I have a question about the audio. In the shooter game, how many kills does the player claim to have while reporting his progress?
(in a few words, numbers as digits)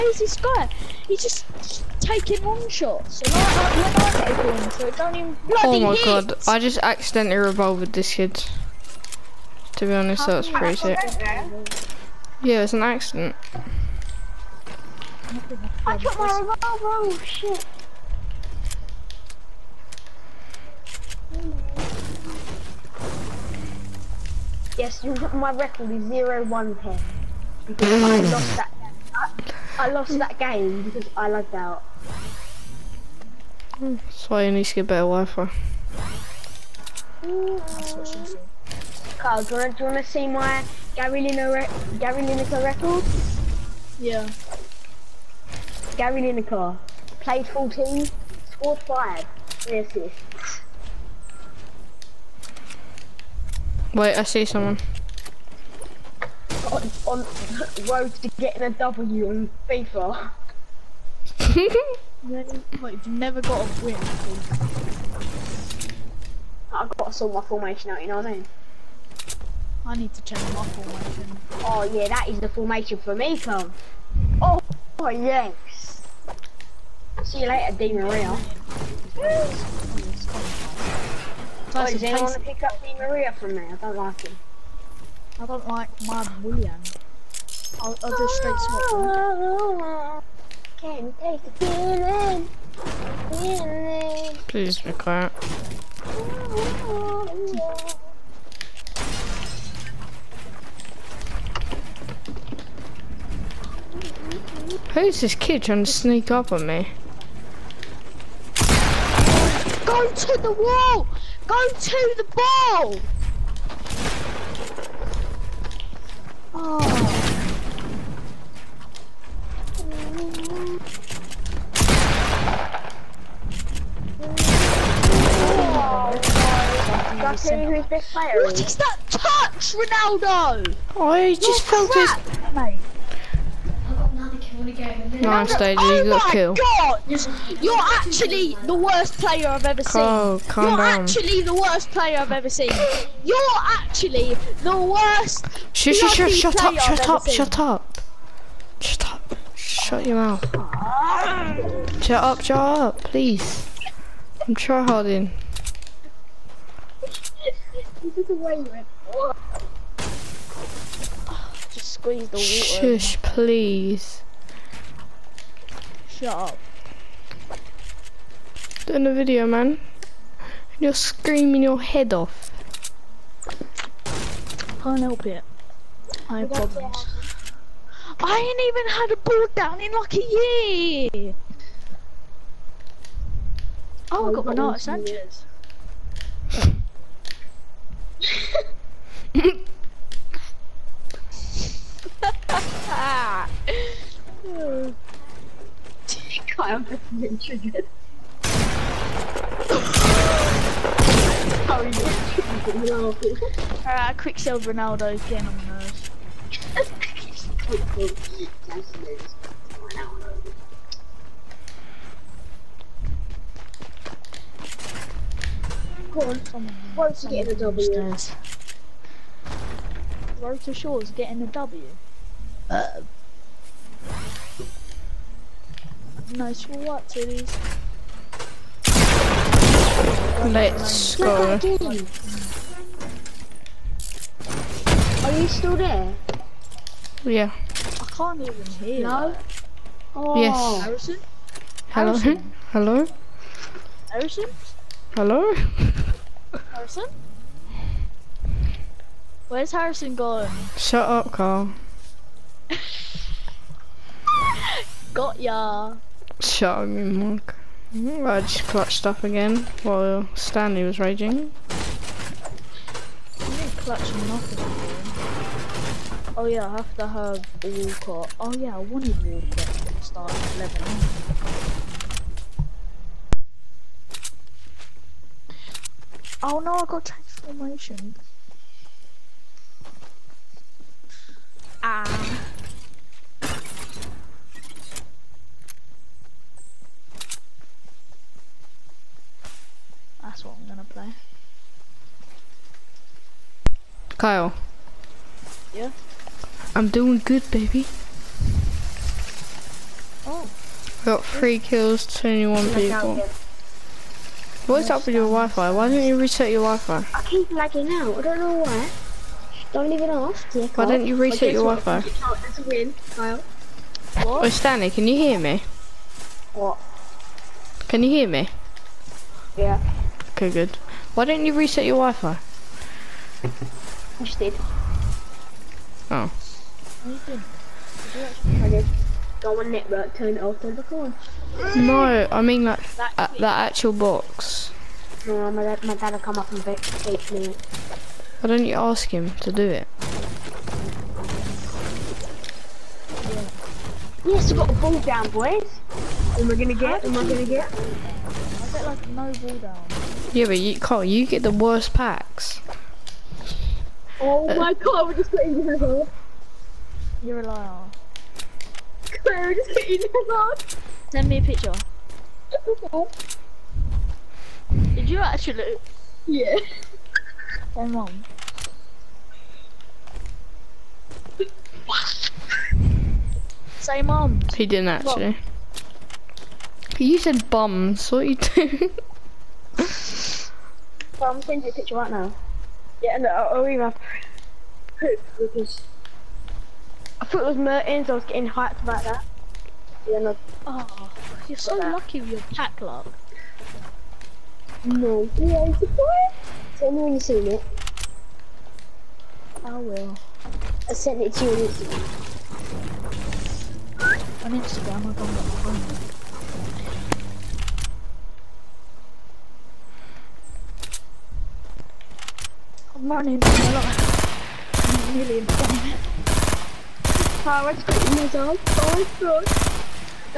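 3.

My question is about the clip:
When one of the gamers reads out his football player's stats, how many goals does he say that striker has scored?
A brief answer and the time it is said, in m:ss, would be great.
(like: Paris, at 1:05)
5, at 0:48.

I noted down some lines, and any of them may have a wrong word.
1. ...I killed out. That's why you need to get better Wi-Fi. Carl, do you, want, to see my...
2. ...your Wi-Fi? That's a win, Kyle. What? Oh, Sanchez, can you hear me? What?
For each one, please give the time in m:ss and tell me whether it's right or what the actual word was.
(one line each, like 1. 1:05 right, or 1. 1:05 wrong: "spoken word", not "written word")
1. 0:31 wrong: "lagged", not "killed"
2. 5:11 wrong: "Stanley", not "Sanchez".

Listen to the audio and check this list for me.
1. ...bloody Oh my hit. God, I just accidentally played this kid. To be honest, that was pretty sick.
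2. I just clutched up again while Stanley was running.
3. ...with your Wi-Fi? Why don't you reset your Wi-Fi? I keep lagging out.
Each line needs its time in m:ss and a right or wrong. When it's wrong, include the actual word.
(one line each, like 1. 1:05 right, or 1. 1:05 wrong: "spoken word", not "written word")
1. 0:05 wrong: "revolved", not "played"
2. 4:17 wrong: "raging", not "running"
3. 5:05 right.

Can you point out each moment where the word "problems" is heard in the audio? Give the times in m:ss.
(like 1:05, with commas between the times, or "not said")
2:56.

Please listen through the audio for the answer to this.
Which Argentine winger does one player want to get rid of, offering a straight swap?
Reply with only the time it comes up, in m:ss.
1:22.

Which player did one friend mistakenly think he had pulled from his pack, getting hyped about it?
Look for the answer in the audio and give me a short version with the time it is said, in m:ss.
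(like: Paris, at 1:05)
Mertens, at 6:27.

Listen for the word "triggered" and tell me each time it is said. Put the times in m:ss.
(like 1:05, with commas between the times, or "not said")
3:17, 3:21.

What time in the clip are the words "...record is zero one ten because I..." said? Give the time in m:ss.
0:25.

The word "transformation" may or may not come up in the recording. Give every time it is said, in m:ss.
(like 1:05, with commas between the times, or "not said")
4:37.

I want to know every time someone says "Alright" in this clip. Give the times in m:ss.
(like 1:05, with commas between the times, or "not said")
3:23.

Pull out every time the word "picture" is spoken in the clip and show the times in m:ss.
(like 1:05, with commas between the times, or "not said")
6:01, 6:21.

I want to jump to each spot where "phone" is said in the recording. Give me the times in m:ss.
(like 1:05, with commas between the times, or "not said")
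6:45.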